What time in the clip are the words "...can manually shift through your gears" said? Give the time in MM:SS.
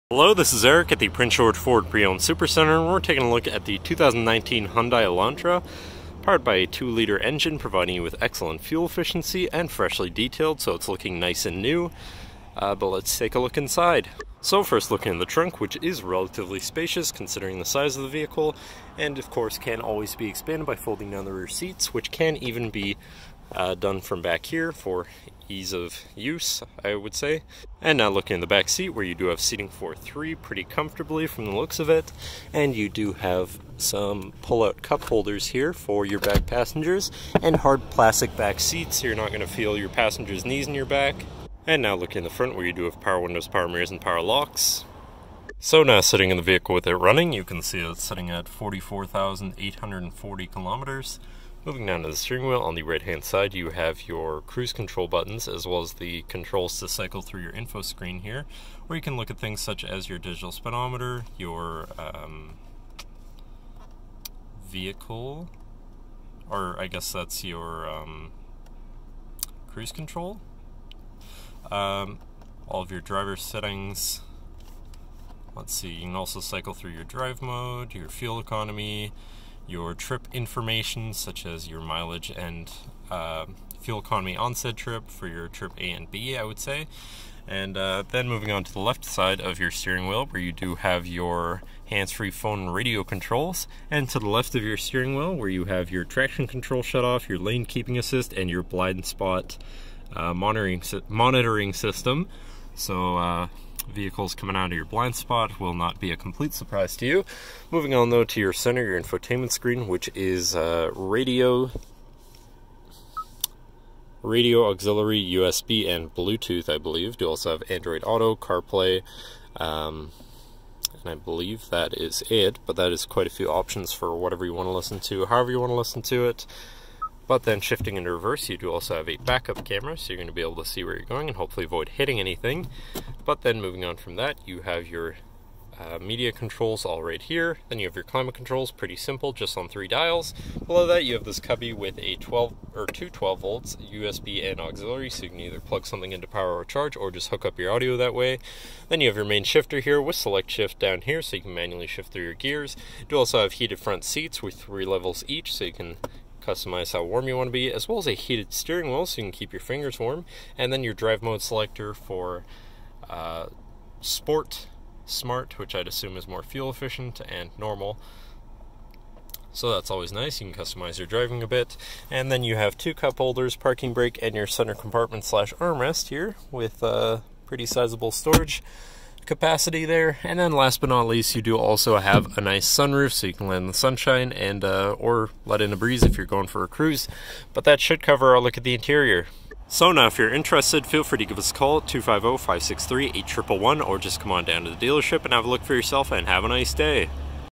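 02:31.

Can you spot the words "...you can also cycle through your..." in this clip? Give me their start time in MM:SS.
01:15.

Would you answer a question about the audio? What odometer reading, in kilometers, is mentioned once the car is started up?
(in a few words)
44,840.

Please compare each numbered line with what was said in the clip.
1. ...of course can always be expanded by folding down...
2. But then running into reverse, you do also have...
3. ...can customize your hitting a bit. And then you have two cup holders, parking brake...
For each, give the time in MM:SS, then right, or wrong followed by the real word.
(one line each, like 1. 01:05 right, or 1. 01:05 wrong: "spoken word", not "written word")
1. 00:19 right
2. 02:07 wrong: "shifting", not "running"
3. 02:50 wrong: "driving", not "hitting".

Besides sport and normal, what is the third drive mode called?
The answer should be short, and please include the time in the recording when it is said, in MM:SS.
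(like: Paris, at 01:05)
Smart, at 02:45.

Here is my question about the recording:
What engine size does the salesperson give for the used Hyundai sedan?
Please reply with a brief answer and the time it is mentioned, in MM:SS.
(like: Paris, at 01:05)
2-liter, at 00:06.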